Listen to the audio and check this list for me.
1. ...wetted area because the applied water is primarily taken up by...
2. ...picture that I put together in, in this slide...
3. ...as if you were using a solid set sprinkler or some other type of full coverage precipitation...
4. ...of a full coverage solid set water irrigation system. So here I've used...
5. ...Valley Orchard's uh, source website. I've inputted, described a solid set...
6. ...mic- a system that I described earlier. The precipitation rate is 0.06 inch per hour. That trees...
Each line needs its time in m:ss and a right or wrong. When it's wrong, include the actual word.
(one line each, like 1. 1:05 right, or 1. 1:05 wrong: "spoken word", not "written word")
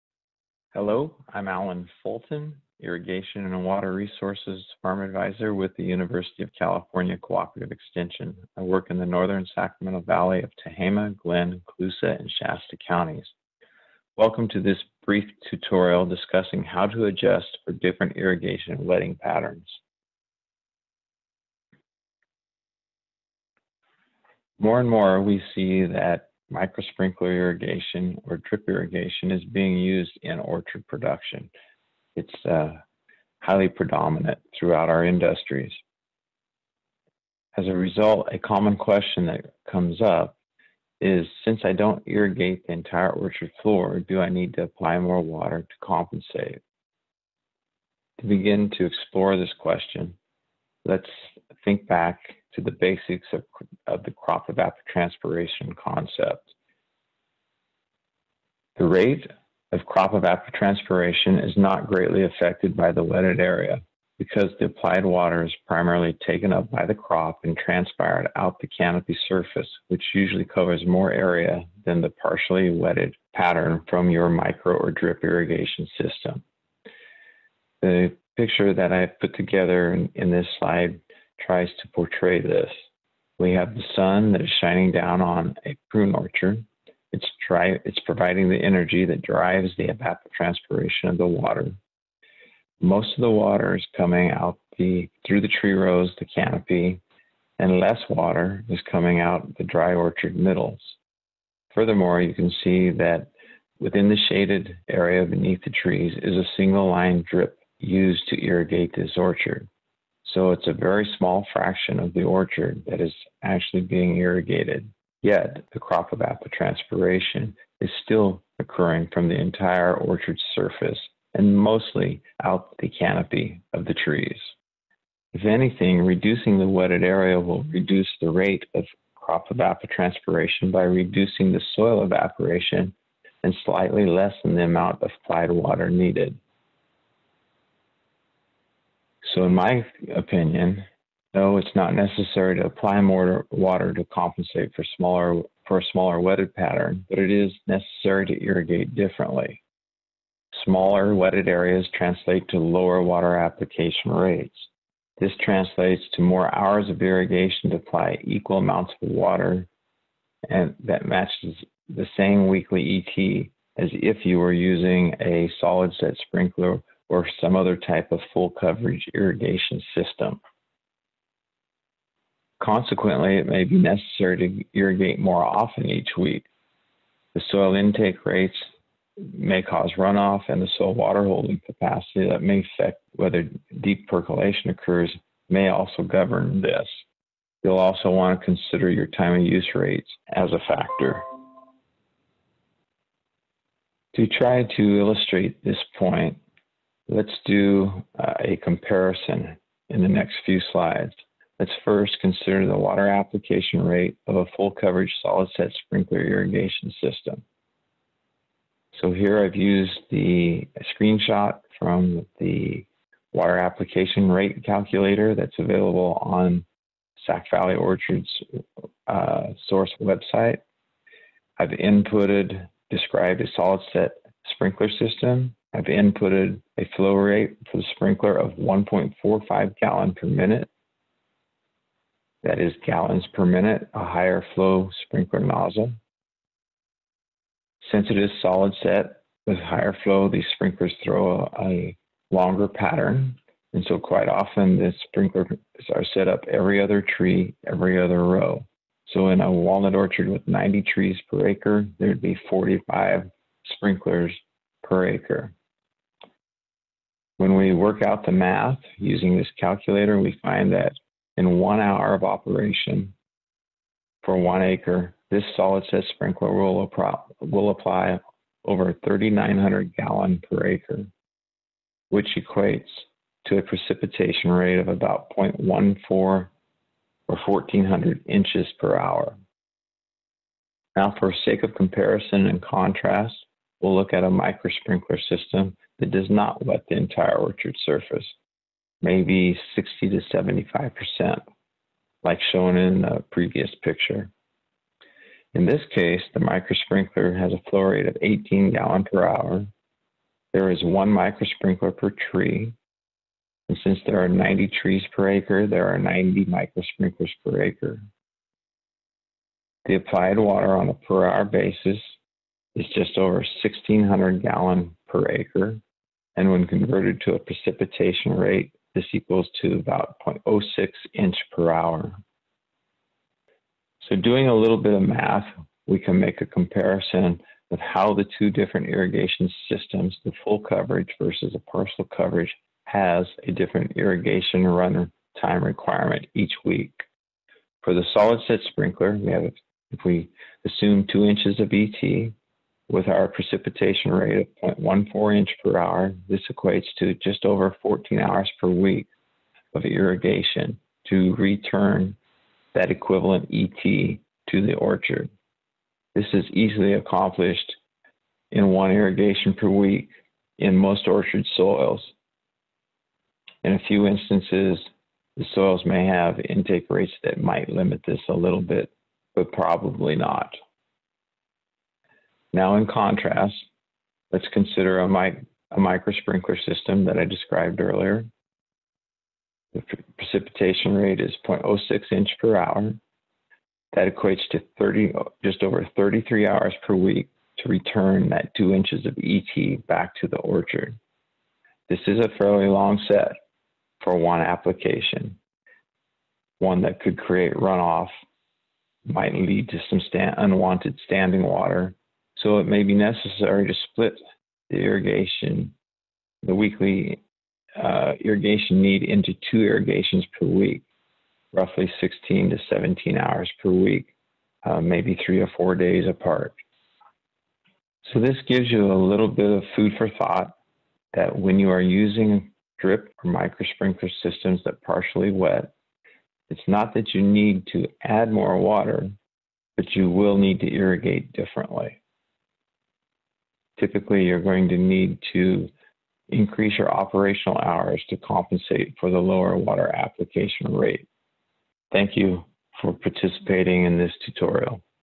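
1. 1:03 right
2. 1:18 right
3. 2:43 wrong: "irrigation", not "precipitation"
4. 3:24 wrong: "sprinkler", not "water"
5. 3:37 right
6. 6:15 wrong: "equates", not "trees".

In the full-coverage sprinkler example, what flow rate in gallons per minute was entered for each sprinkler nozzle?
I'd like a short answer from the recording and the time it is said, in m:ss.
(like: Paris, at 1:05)
1.45, at 3:48.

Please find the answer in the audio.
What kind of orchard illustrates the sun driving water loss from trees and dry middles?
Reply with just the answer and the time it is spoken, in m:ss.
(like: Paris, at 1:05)
Prune, at 1:25.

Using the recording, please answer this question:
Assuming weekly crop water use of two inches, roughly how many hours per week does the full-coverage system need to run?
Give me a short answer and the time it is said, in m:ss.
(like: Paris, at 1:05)
14, at 5:47.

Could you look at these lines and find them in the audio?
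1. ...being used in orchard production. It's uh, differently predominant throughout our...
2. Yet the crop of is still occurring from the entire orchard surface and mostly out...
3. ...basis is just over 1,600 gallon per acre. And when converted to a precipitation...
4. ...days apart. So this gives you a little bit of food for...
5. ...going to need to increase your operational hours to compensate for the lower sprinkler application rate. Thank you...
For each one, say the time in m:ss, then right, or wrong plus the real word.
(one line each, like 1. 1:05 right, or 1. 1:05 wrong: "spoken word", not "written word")
1. 0:29 wrong: "highly", not "differently"
2. 1:55 right
3. 5:11 right
4. 6:55 right
5. 7:14 wrong: "water", not "sprinkler".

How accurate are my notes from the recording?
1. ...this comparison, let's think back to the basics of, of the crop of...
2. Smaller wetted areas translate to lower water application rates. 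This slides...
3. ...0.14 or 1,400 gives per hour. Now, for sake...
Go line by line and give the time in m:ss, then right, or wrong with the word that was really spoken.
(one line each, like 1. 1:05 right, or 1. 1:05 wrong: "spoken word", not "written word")
1. 0:49 wrong: "question", not "comparison"
2. 2:30 wrong: "translates", not "slides"
3. 4:35 wrong: "inches", not "gives".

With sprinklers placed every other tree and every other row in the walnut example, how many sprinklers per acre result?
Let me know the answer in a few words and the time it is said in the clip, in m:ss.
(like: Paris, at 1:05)
45, at 4:12.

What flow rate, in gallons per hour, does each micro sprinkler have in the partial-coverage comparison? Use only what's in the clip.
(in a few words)
18 gallons per hour.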